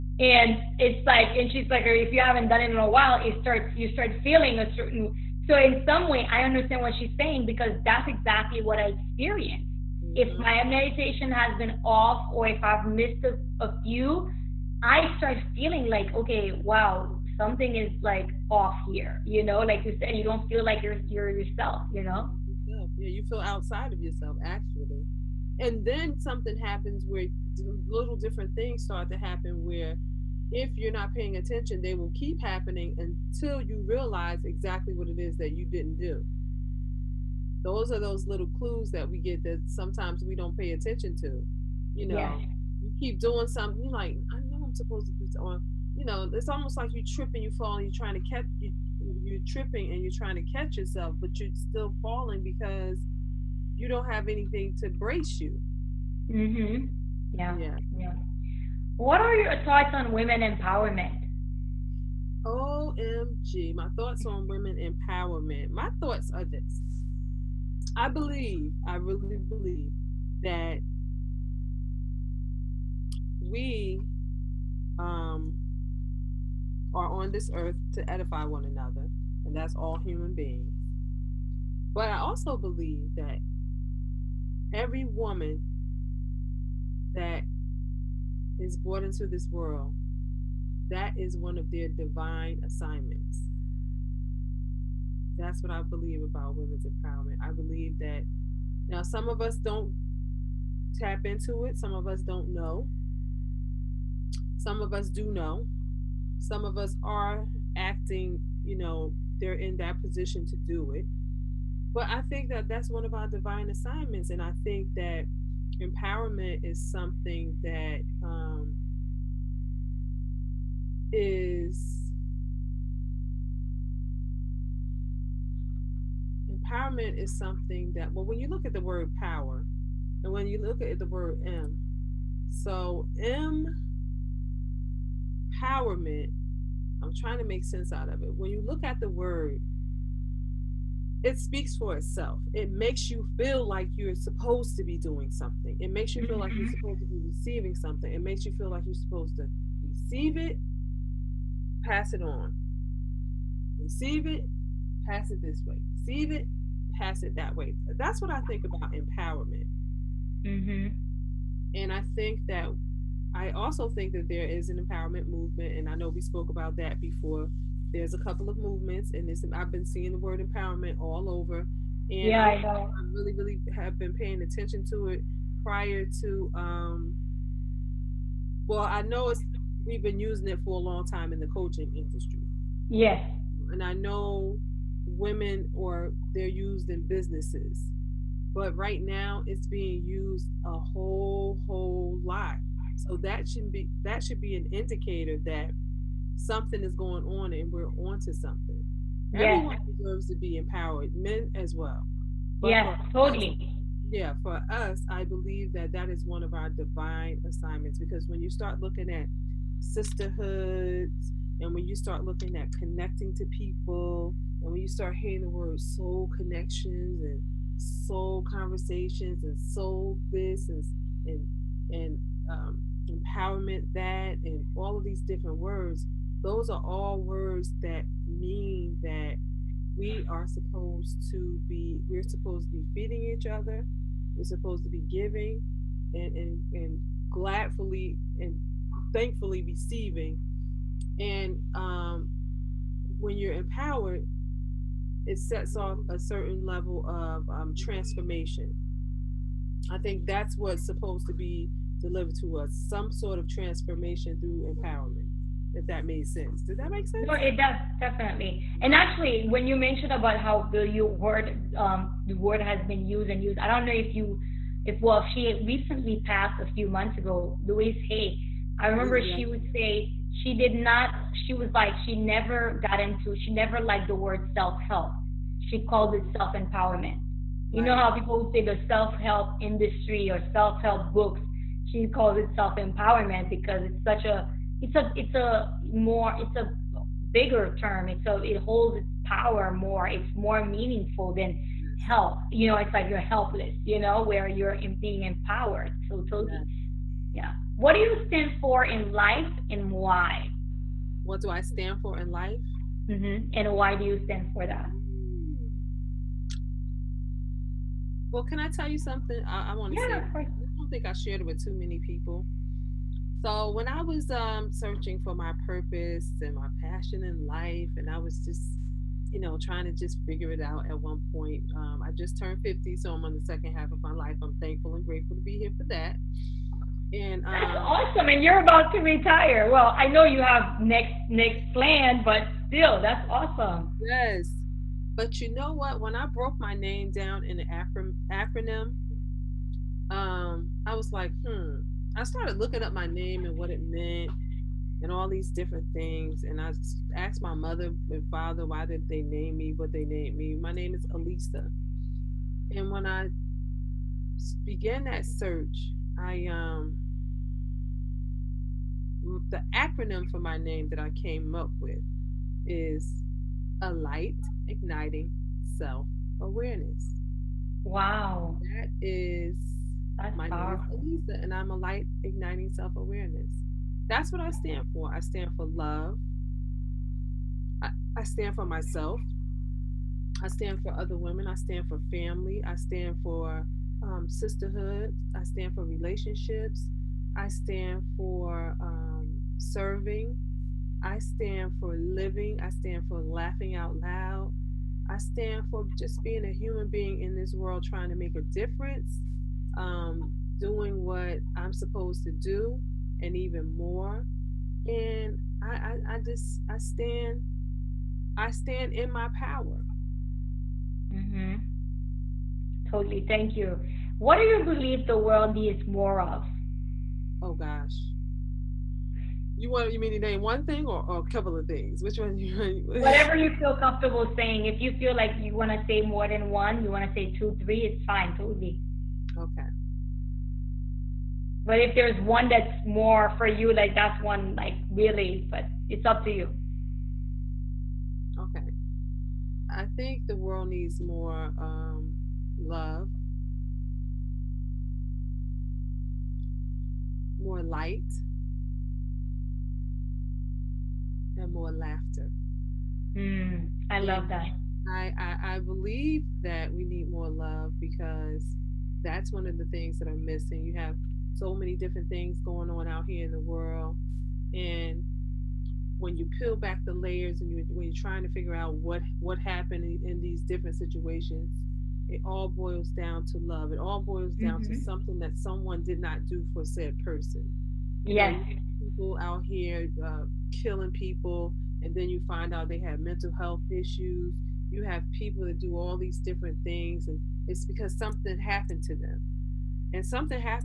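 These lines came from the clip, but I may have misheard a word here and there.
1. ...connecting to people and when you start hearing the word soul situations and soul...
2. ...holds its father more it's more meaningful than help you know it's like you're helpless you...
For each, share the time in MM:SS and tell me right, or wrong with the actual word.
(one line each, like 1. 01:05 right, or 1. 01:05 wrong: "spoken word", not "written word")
1. 03:32 wrong: "connections", not "situations"
2. 04:48 wrong: "power", not "father".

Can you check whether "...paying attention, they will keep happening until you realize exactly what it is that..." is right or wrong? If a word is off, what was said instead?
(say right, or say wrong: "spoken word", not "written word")
right.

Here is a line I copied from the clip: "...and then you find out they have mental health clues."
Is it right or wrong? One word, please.
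wrong.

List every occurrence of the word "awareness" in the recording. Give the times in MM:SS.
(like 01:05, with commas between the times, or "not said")
06:06, 06:12.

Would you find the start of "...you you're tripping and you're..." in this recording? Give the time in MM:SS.
00:48.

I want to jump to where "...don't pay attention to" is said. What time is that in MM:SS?
00:40.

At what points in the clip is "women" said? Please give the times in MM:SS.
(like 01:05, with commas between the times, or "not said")
01:00, 01:04, 01:36, 03:05, 06:21.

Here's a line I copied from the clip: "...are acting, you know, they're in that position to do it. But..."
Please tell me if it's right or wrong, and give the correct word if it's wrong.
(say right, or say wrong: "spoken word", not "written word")
right.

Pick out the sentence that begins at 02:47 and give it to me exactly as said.
There's a couple of movements, and this I've been seeing the word empowerment all over.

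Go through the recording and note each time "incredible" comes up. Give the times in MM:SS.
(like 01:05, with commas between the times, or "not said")
not said.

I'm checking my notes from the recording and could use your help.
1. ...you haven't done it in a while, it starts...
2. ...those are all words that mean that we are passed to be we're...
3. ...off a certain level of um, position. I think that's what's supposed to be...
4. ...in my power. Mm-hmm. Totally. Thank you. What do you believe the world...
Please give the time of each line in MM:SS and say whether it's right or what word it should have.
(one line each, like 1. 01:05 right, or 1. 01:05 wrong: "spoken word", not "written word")
1. 00:02 right
2. 03:46 wrong: "supposed", not "passed"
3. 04:05 wrong: "transformation", not "position"
4. 06:48 right.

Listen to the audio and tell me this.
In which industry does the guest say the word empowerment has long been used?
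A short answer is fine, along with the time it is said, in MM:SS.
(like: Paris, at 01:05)
coaching industry, at 03:01.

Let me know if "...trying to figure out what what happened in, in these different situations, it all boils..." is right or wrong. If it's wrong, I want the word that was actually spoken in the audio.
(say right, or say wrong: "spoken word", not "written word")
right.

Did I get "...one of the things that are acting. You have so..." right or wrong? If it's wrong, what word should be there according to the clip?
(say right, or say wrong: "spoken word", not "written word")
wrong: "missing", not "acting".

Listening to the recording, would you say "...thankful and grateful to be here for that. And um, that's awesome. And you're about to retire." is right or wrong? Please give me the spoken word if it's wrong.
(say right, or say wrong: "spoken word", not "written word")
right.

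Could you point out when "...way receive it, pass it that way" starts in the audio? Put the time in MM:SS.
02:35.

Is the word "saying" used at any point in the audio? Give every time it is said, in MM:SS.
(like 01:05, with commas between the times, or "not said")
00:07, 07:04.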